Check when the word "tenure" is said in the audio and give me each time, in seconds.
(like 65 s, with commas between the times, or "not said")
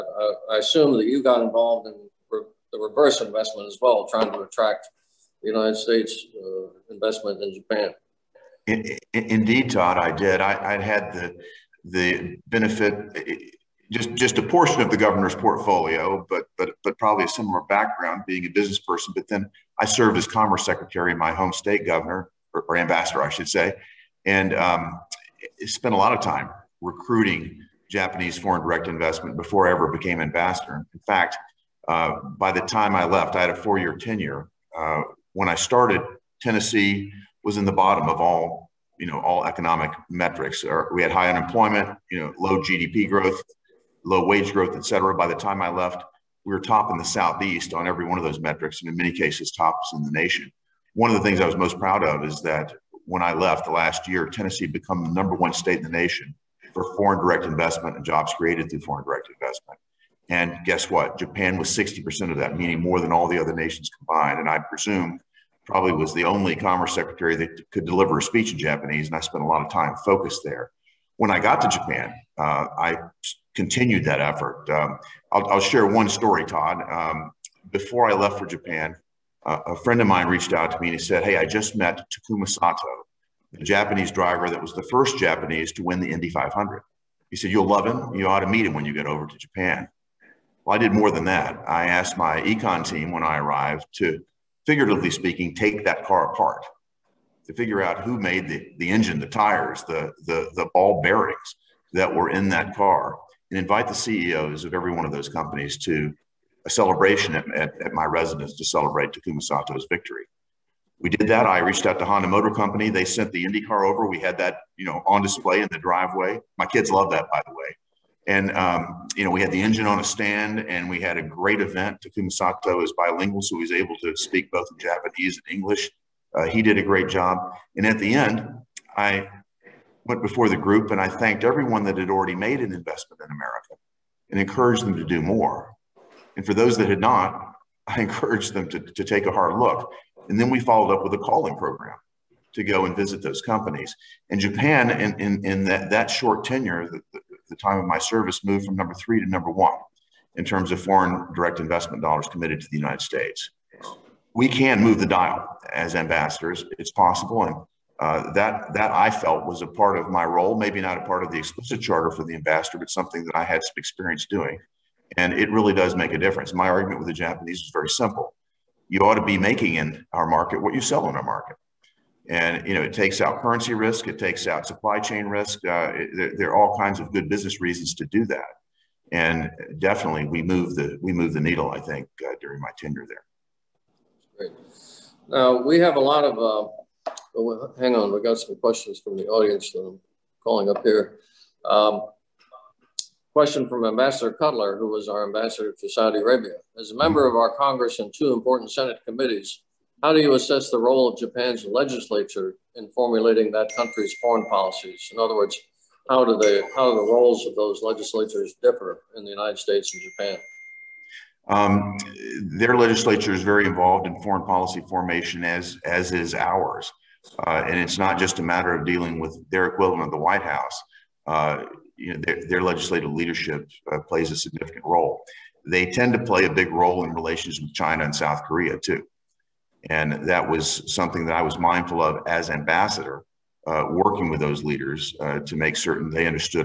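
33 s, 146 s, 182 s.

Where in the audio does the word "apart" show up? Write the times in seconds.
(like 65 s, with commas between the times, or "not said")
96 s.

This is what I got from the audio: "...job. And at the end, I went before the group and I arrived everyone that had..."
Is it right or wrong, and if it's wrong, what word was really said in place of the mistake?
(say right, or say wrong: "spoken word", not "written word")
wrong: "thanked", not "arrived".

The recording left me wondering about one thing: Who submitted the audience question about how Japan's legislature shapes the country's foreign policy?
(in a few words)
Ambassador Cutler.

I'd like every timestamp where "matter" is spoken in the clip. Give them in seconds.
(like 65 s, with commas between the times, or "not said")
218 s.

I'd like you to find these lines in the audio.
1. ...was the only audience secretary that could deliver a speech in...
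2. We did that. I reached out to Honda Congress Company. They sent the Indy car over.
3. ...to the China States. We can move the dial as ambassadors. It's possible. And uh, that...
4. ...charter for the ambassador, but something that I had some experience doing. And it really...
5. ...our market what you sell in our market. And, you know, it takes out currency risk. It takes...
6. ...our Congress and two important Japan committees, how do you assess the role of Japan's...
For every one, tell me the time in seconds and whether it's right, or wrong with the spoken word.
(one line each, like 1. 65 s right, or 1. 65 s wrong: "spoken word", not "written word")
1. 65 s wrong: "commerce", not "audience"
2. 110 s wrong: "Motor", not "Congress"
3. 152 s wrong: "United", not "China"
4. 161 s right
5. 170 s right
6. 197 s wrong: "Senate", not "Japan".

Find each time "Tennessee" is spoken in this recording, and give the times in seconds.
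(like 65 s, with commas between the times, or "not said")
36 s, 54 s.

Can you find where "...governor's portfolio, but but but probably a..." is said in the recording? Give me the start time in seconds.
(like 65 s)
14 s.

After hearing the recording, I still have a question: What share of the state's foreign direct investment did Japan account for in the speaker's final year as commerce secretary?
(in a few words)
60%.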